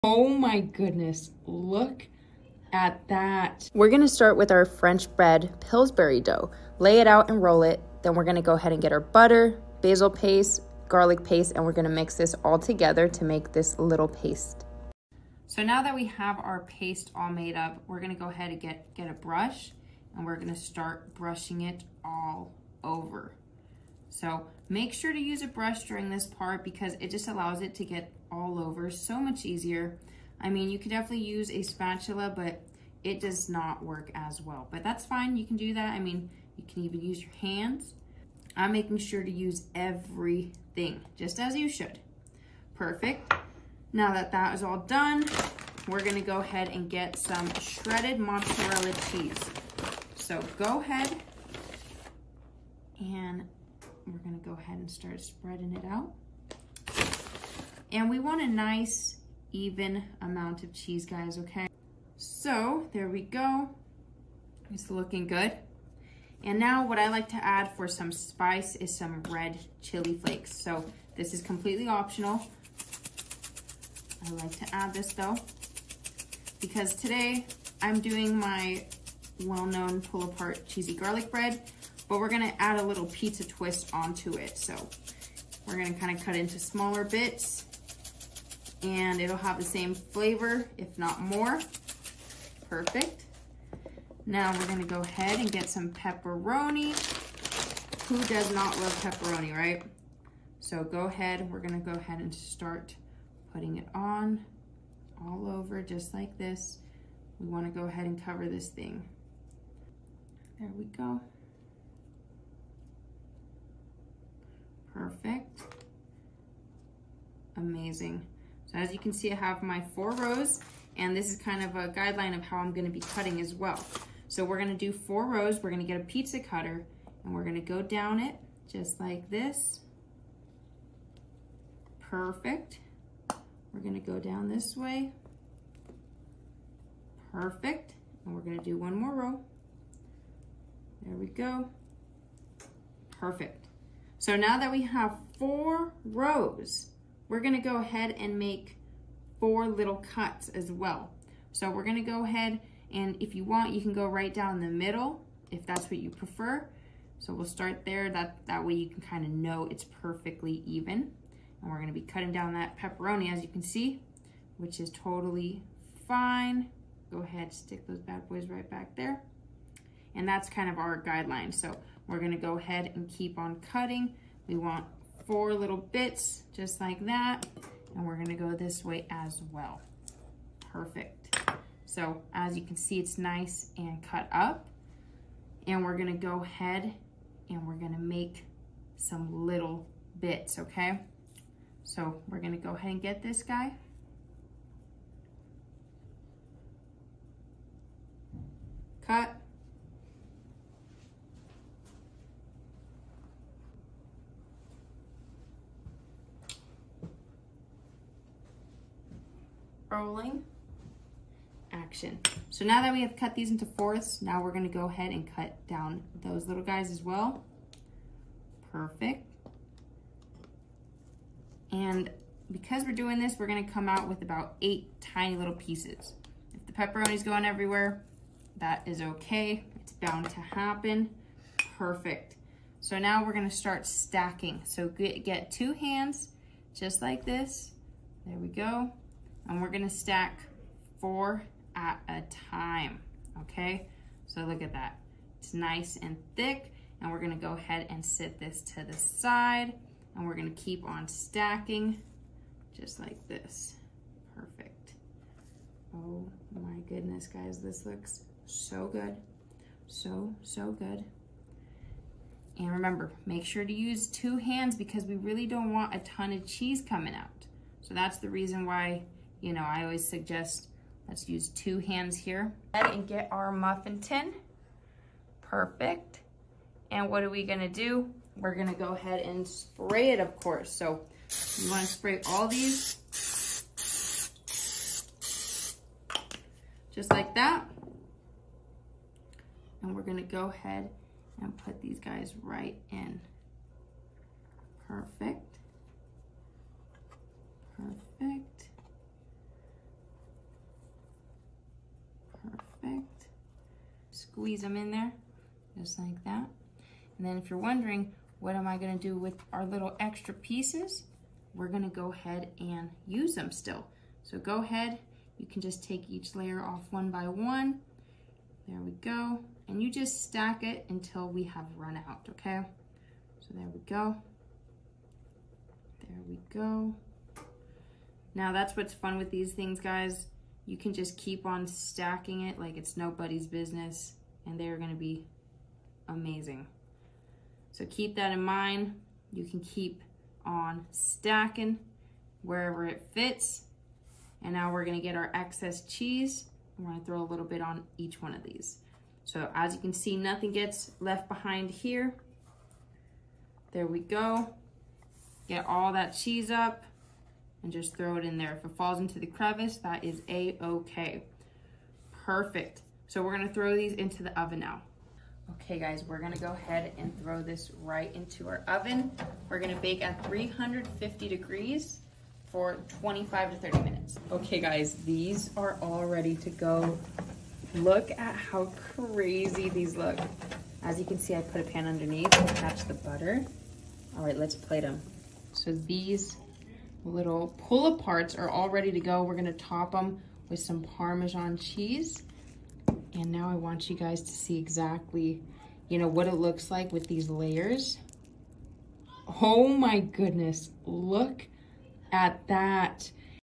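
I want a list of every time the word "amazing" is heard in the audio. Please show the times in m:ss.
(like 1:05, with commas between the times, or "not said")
1:57, 5:36.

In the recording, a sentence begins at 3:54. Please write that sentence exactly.
So get, get two hands, just like this.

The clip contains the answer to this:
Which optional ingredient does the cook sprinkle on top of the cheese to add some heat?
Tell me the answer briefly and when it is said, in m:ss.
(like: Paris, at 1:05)
red chili flakes, at 1:09.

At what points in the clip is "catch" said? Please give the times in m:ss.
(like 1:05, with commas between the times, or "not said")
6:22.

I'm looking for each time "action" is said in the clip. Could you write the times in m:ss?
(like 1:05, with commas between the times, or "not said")
3:31.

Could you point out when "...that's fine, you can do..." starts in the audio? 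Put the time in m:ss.
0:34.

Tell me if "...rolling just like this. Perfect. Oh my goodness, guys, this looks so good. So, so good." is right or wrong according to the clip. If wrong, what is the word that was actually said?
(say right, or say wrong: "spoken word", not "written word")
wrong: "stacking", not "rolling".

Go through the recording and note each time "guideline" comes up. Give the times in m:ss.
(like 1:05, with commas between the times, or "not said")
2:01, 2:51.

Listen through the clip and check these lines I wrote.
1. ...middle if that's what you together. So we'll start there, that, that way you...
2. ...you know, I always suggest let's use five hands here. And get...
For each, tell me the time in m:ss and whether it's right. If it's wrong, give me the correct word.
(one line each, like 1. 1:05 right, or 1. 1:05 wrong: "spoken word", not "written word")
1. 2:34 wrong: "prefer", not "together"
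2. 4:29 wrong: "two", not "five".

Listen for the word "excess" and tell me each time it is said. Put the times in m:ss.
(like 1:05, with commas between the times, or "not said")
5:45.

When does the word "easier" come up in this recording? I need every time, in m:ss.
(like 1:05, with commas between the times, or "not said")
0:29.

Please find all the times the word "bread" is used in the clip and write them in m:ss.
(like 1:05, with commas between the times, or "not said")
0:05, 1:21.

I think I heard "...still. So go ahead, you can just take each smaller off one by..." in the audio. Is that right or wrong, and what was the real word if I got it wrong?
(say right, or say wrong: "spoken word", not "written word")
wrong: "layer", not "smaller".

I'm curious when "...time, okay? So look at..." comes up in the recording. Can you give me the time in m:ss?
4:02.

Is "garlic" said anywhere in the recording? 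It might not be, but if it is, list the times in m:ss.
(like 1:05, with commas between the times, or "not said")
0:10, 1:20.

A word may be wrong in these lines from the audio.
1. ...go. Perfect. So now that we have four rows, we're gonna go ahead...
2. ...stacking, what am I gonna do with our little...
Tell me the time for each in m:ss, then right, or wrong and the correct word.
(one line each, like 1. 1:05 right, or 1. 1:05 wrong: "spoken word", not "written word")
1. 2:21 right
2. 5:07 wrong: "wondering", not "stacking".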